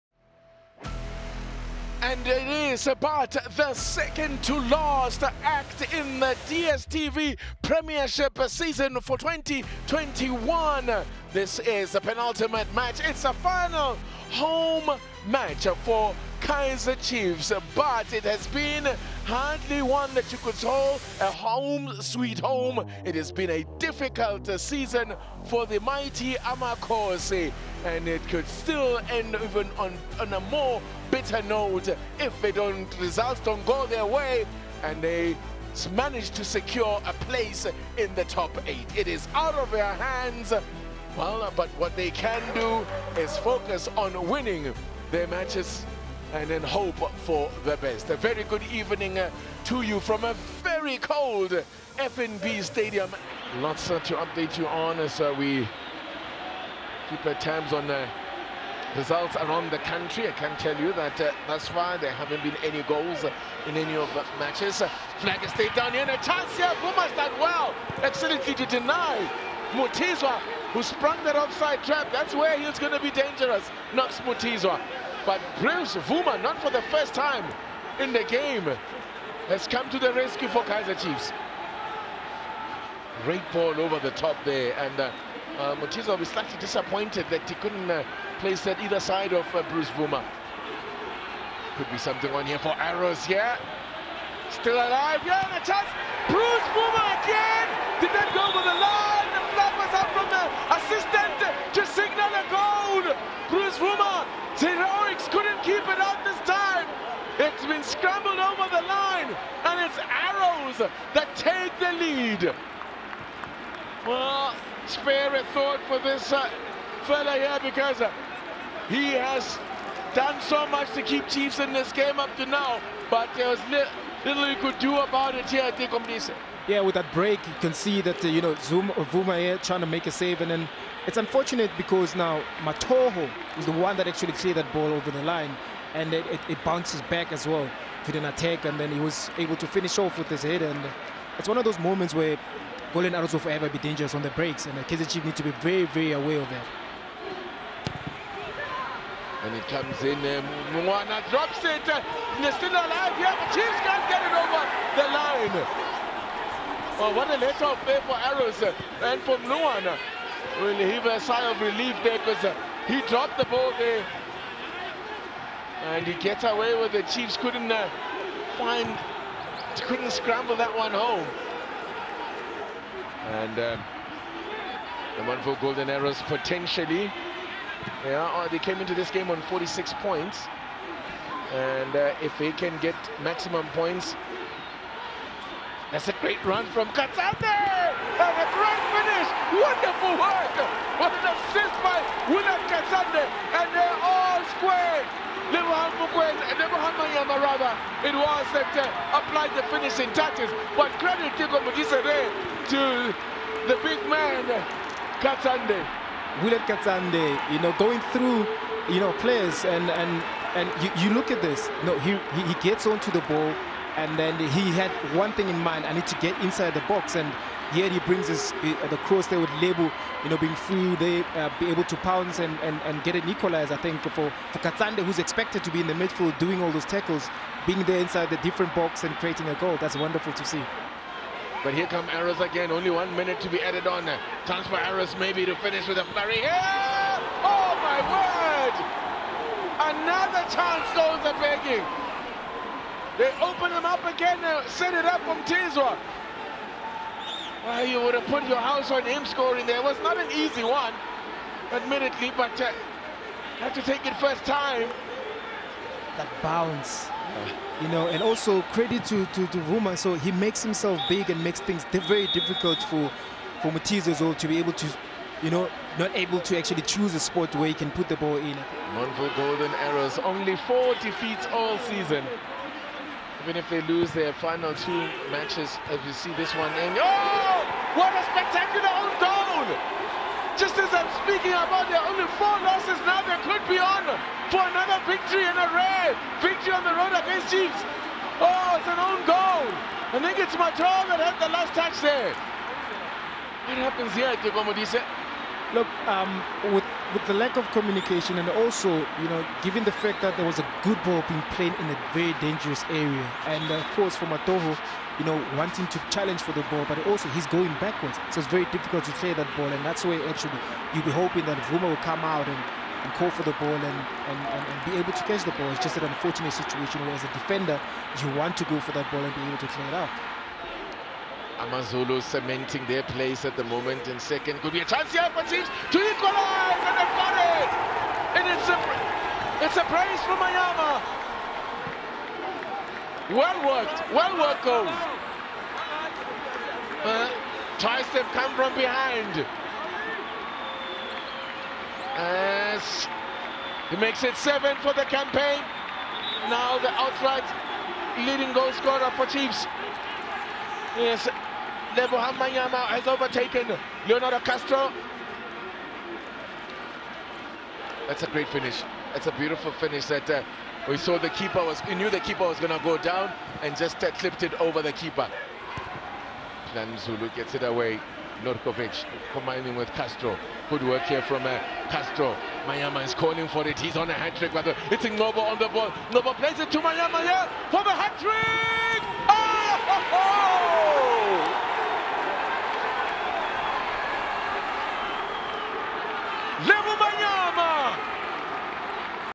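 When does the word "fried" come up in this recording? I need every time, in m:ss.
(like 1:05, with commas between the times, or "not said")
not said.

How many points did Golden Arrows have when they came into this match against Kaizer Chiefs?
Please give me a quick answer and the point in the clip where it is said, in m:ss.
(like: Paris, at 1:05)
46, at 2:59.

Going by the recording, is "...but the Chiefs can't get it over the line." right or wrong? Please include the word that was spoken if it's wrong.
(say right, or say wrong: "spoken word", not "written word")
right.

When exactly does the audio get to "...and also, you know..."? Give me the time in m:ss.
4:58.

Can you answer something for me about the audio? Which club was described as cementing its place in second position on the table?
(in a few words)
Amazulu.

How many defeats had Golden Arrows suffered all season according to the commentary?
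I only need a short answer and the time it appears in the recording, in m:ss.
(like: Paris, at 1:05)
4, at 4:30.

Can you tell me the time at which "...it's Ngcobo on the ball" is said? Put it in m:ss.
6:14.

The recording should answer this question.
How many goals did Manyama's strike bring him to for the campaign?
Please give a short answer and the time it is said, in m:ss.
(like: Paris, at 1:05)
7, at 5:44.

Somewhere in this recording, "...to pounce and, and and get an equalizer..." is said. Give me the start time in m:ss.
3:41.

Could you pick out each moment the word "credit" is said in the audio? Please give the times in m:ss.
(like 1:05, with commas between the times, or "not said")
3:21, 4:18.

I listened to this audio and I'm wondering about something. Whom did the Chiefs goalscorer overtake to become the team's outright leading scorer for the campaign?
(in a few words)
Leonardo Castro.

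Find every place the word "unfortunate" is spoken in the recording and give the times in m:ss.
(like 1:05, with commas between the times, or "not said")
2:11, 5:16.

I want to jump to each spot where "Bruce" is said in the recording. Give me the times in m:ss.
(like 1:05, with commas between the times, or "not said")
1:15, 1:29, 1:36.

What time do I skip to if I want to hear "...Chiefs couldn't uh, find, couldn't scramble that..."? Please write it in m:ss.
2:47.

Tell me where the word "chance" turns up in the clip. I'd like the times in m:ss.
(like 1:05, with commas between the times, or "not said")
1:06, 1:35, 3:54, 4:00, 5:24.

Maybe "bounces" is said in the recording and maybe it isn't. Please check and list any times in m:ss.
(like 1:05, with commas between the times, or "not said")
2:16, 4:16.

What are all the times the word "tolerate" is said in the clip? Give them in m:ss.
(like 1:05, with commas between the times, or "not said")
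not said.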